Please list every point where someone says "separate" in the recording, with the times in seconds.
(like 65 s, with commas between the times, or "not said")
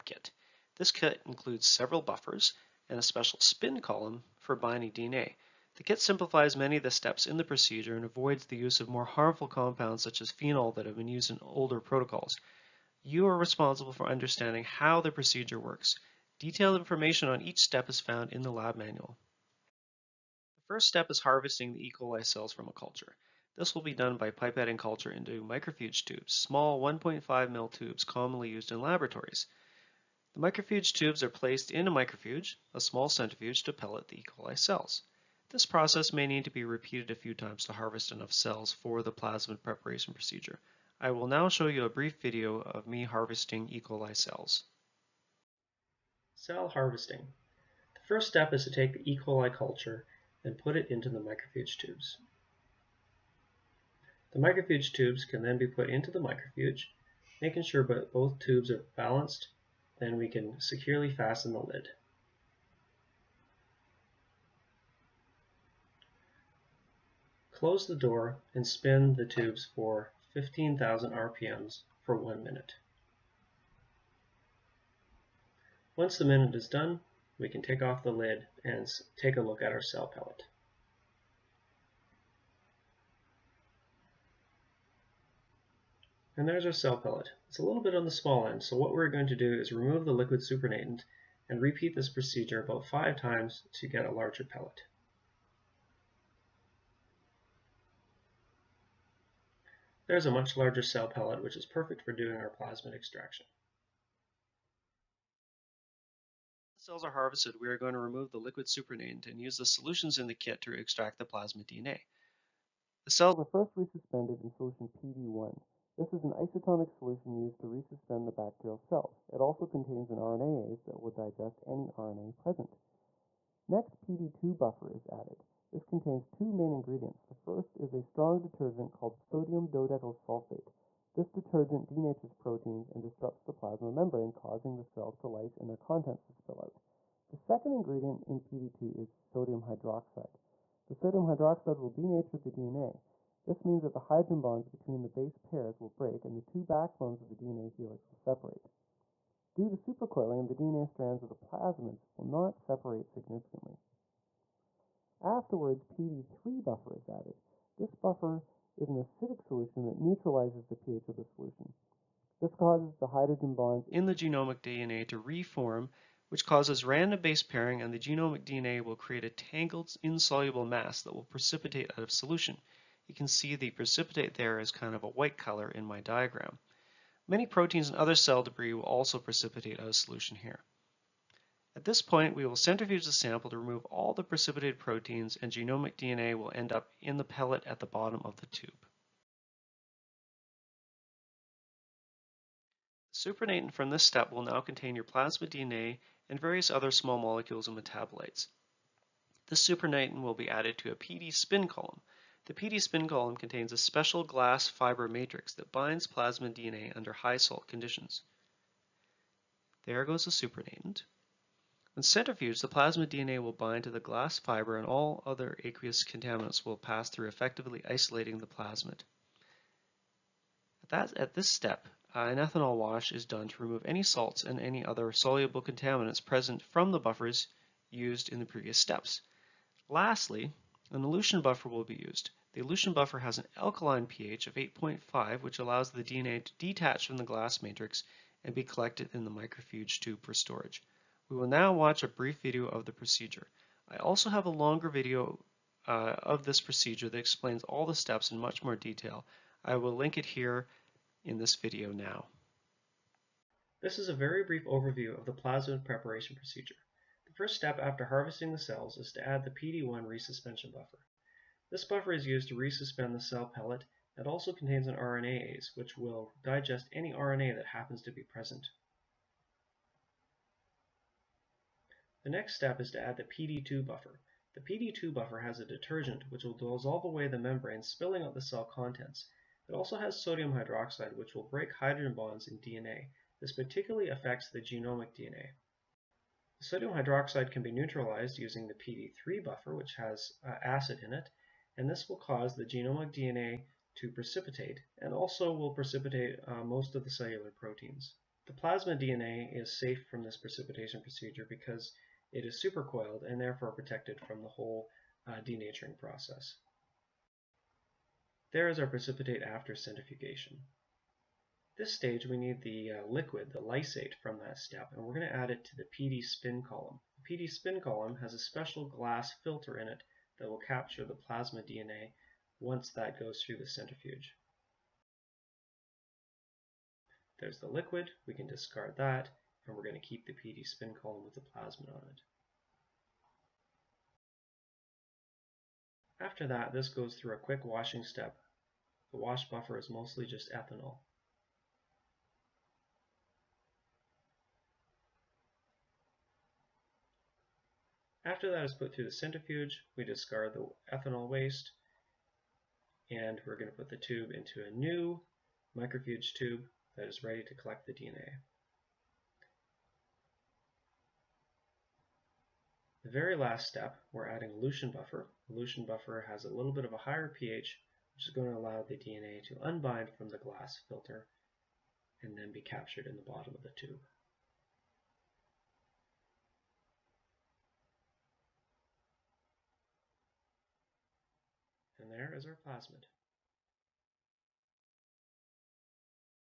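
148 s, 152 s.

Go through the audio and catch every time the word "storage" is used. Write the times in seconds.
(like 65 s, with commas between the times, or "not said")
240 s.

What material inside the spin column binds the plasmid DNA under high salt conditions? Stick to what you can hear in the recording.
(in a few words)
glass fiber matrix.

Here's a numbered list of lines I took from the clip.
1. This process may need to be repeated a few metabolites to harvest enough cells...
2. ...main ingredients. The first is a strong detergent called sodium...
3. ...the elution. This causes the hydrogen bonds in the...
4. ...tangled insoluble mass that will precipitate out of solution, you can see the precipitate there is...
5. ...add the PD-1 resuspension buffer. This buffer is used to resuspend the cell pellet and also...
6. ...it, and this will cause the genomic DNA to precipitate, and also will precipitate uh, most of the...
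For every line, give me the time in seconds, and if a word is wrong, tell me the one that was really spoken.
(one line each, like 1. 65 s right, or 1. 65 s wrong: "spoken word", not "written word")
1. 35 s wrong: "times", not "metabolites"
2. 126 s right
3. 161 s wrong: "solution", not "elution"
4. 169 s right
5. 259 s right
6. 291 s right.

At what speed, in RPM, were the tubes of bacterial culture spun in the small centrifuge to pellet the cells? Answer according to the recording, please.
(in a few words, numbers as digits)
15,000.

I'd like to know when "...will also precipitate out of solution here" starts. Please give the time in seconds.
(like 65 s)
178 s.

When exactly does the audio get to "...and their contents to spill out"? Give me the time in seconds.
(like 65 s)
135 s.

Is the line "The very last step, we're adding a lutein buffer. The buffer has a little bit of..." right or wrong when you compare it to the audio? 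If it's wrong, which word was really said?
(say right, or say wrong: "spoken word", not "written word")
right.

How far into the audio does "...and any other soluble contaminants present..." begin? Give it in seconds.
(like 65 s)
224 s.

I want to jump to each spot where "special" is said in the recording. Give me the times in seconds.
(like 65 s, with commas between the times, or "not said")
3 s, 203 s, 318 s.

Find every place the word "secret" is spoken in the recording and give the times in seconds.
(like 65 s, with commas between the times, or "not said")
not said.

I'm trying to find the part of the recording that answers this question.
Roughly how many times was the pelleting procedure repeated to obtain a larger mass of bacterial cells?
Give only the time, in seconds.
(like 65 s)
92 s.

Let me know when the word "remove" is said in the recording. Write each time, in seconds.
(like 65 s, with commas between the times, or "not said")
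89 s, 107 s, 183 s, 223 s.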